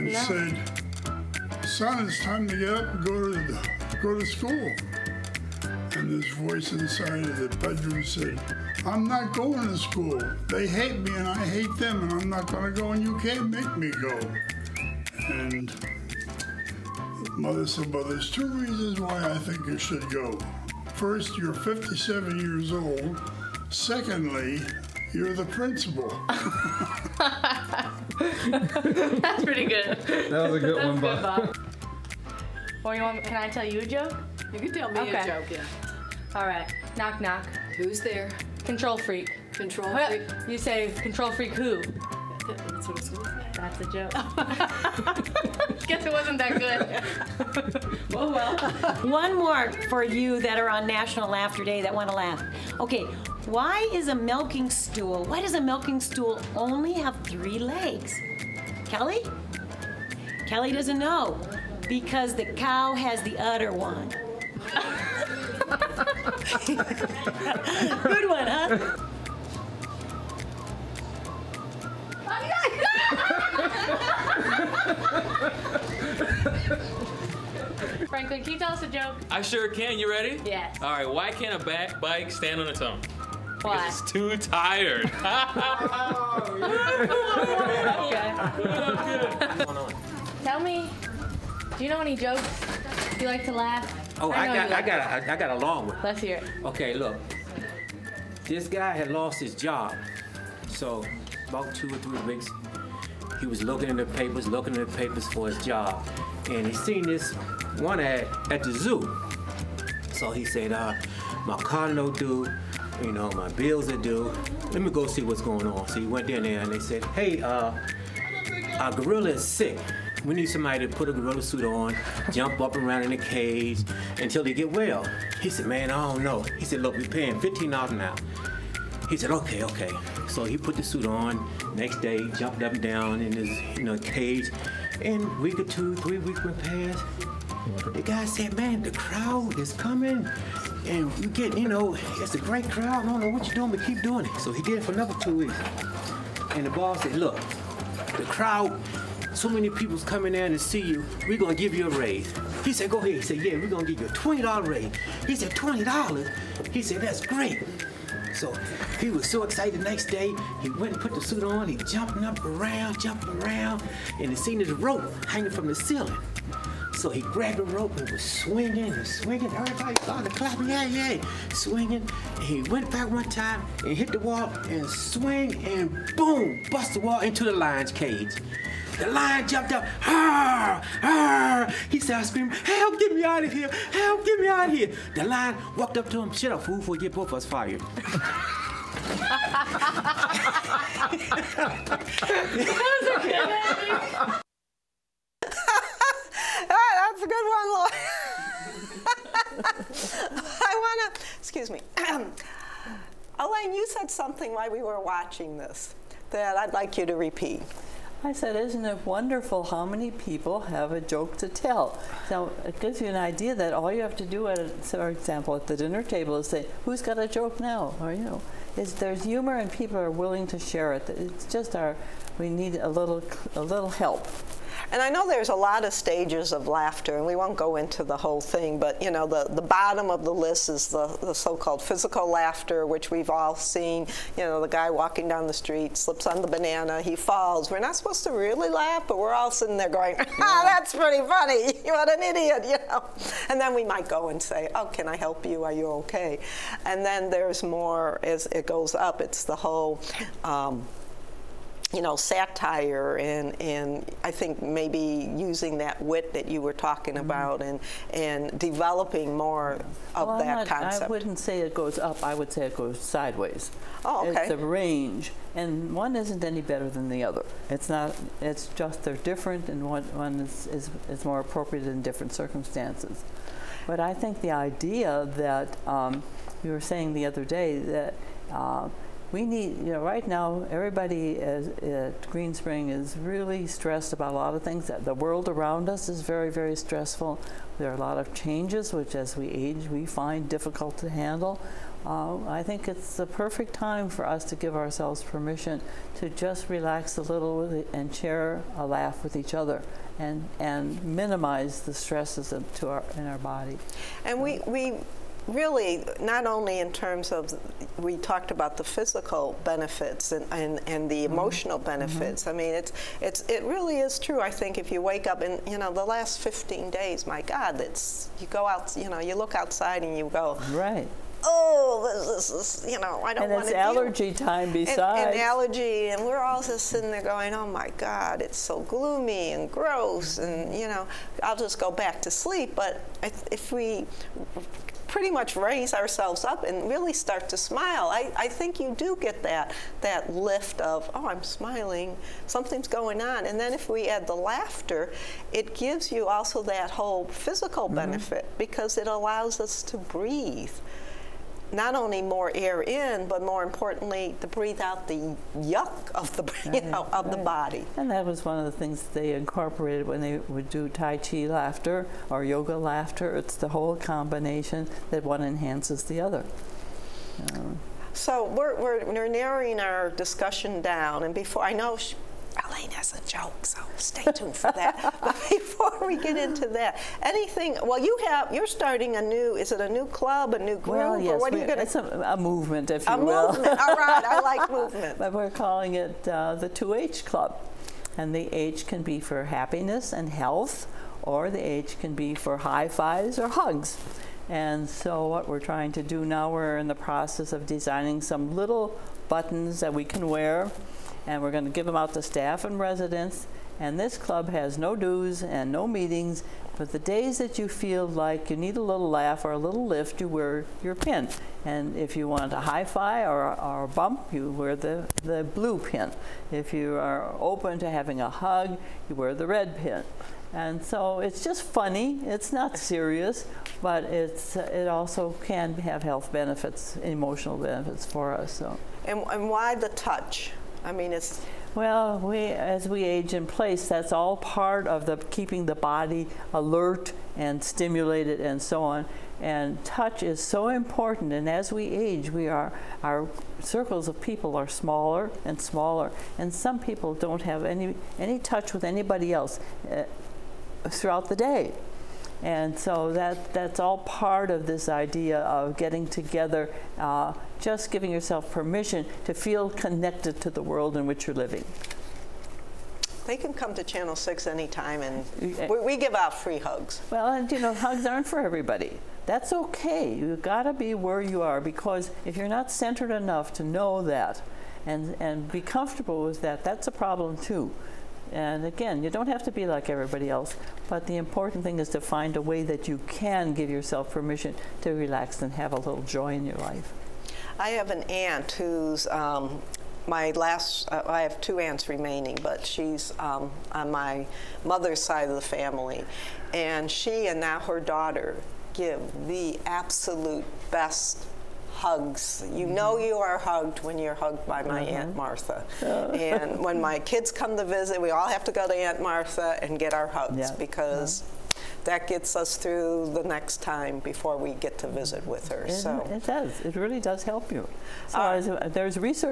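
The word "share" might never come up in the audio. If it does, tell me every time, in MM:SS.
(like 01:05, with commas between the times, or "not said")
03:40, 04:58.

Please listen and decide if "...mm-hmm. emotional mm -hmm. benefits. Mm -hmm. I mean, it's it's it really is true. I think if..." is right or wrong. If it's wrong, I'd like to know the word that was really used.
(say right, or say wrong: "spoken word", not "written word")
right.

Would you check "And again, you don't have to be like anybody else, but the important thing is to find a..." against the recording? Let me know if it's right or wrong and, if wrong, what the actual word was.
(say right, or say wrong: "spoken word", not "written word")
wrong: "everybody", not "anybody".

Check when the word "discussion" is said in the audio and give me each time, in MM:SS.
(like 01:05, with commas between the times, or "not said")
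06:10.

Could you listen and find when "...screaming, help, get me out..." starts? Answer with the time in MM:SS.
03:02.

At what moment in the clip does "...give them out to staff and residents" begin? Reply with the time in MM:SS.
06:41.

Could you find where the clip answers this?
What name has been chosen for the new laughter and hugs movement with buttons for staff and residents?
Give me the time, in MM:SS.
06:26.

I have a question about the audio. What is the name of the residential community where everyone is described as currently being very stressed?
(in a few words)
Greenspring.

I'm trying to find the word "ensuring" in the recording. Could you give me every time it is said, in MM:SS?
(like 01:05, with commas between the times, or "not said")
not said.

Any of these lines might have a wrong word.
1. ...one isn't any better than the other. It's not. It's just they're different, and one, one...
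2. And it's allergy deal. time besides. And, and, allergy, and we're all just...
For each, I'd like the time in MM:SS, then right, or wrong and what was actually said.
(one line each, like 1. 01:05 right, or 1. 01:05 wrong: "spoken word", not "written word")
1. 04:25 right
2. 05:23 right.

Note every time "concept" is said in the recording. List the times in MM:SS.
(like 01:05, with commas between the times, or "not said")
04:20.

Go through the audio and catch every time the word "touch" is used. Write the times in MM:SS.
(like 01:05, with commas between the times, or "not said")
07:09, 07:19, 07:28.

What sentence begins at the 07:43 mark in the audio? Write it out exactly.
They can come to Channel 6 anytime, and we, we give out free hugs.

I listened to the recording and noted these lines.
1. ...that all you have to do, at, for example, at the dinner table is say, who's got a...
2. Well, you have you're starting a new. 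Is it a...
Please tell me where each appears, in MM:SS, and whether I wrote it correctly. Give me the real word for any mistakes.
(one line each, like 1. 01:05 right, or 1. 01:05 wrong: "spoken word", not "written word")
1. 03:33 right
2. 06:17 right.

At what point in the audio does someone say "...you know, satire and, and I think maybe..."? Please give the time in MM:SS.
04:11.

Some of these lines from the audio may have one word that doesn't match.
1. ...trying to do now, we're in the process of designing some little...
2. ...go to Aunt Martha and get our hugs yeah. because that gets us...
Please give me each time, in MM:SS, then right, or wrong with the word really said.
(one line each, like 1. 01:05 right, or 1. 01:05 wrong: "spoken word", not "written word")
1. 06:35 right
2. 08:28 right.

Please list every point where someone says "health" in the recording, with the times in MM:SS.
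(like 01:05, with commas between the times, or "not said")
06:30, 07:06.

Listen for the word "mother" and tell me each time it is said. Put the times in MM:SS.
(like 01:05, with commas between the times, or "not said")
00:17, 08:14.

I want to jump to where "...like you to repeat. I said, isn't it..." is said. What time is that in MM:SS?
03:26.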